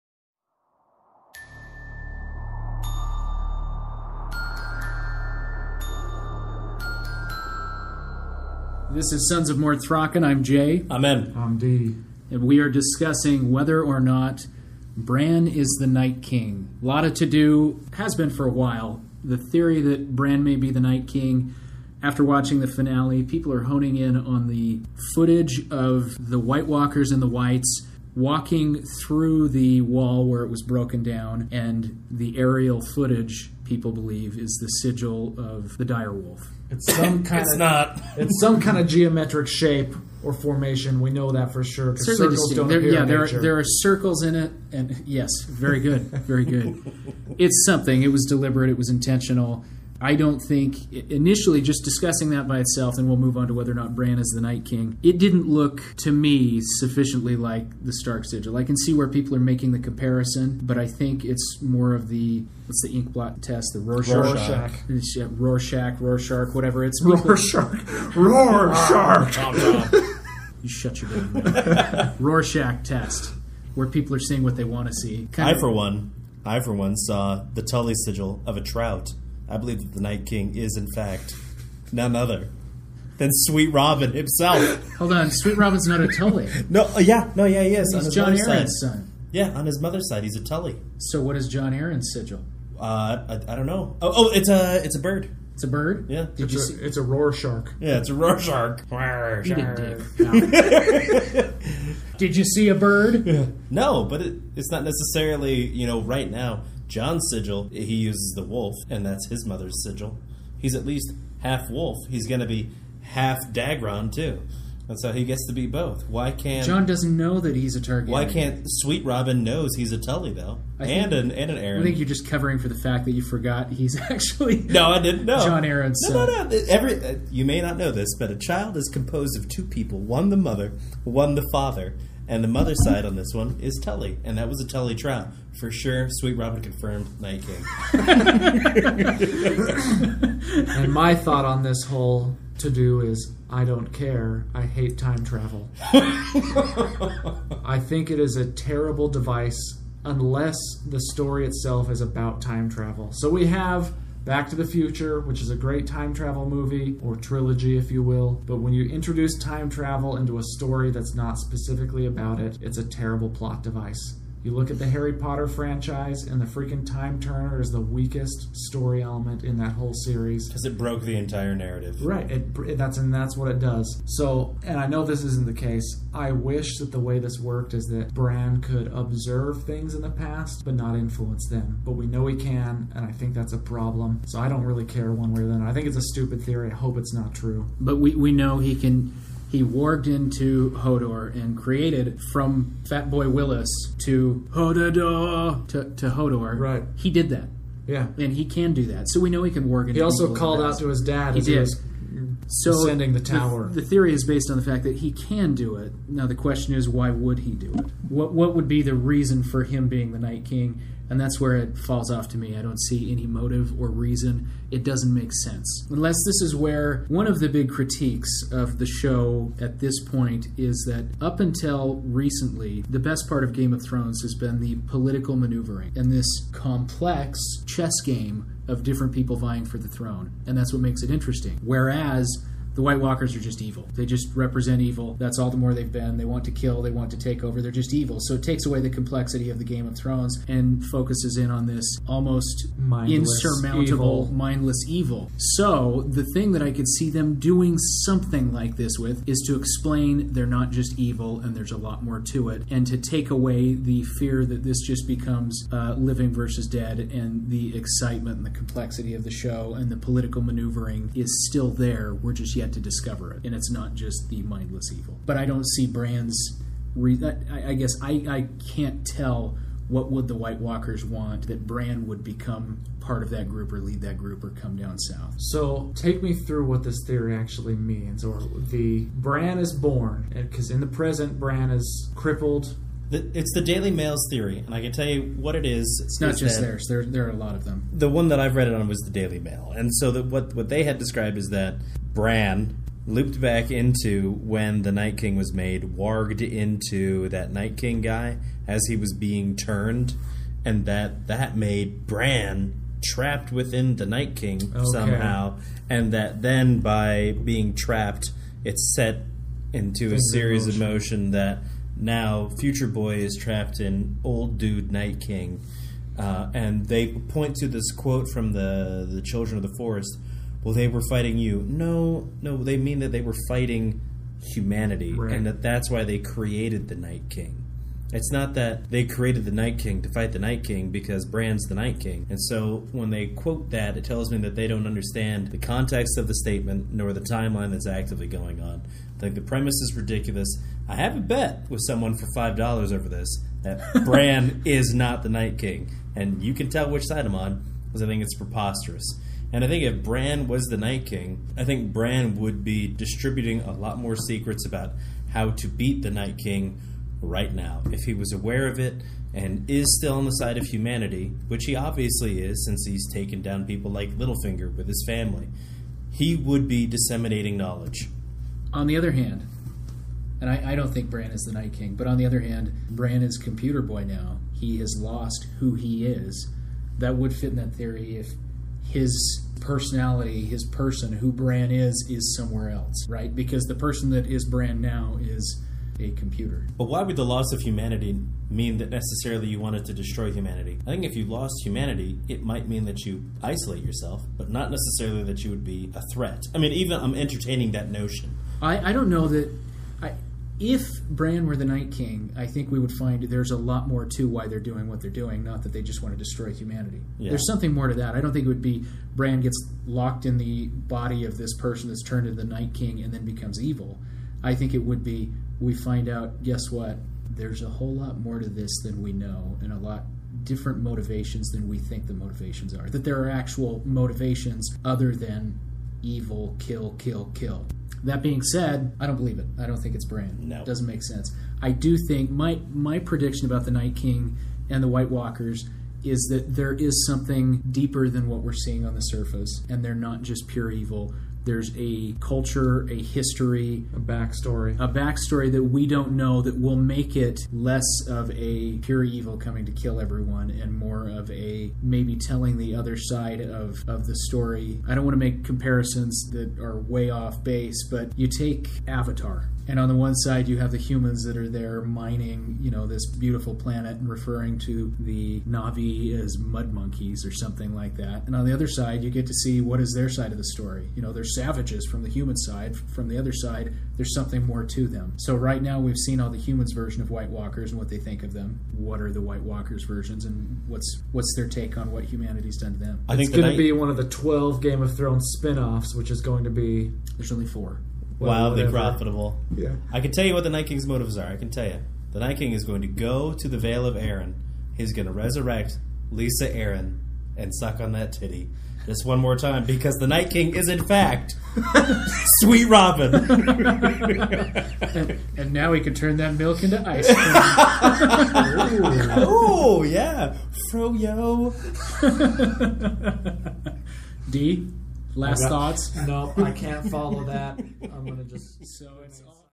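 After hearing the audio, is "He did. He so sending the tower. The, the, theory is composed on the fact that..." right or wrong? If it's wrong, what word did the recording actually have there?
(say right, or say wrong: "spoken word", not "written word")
wrong: "based", not "composed".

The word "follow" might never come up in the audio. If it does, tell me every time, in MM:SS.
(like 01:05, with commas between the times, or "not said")
08:36.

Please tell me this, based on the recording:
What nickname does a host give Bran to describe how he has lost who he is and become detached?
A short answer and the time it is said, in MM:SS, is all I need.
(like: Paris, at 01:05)
Computer Boy, at 06:13.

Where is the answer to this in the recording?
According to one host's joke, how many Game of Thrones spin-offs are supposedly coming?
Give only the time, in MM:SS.
08:04.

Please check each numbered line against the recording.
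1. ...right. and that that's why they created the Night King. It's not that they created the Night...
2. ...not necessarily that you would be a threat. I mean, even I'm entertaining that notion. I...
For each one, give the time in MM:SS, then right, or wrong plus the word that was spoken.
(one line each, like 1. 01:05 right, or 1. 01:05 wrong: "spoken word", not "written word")
1. 05:25 right
2. 06:34 right.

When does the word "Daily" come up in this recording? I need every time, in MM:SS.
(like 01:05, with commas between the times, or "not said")
04:43, 04:49.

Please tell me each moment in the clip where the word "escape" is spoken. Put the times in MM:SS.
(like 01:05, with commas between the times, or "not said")
not said.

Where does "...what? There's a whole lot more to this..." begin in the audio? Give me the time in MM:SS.
06:56.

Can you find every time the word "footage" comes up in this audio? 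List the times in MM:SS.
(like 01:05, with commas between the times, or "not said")
00:25, 00:32.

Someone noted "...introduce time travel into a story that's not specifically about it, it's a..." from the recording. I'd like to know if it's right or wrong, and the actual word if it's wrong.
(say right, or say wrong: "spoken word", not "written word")
right.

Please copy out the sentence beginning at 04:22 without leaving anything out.
We're just yet to discover it, and it's not just the mindless evil.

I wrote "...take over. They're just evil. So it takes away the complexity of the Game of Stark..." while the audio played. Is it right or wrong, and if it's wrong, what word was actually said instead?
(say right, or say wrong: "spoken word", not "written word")
wrong: "Thrones", not "Stark".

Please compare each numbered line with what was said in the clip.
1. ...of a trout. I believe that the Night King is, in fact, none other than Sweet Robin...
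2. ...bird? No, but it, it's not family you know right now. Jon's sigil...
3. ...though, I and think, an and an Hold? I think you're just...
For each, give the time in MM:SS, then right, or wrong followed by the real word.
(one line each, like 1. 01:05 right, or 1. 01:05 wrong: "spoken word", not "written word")
1. 01:18 right
2. 01:42 wrong: "necessarily", not "family"
3. 02:00 wrong: "Arryn", not "Hold".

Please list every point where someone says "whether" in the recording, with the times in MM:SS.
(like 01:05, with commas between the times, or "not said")
00:13, 00:53.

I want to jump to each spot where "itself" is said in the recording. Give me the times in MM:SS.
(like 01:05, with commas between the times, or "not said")
00:52, 02:31.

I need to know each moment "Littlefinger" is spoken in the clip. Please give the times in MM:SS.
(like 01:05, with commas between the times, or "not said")
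06:04.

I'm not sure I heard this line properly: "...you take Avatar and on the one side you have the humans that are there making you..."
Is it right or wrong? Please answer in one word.
wrong.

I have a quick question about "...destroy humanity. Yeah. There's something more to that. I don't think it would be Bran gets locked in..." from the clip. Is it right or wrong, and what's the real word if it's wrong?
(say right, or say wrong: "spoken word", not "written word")
right.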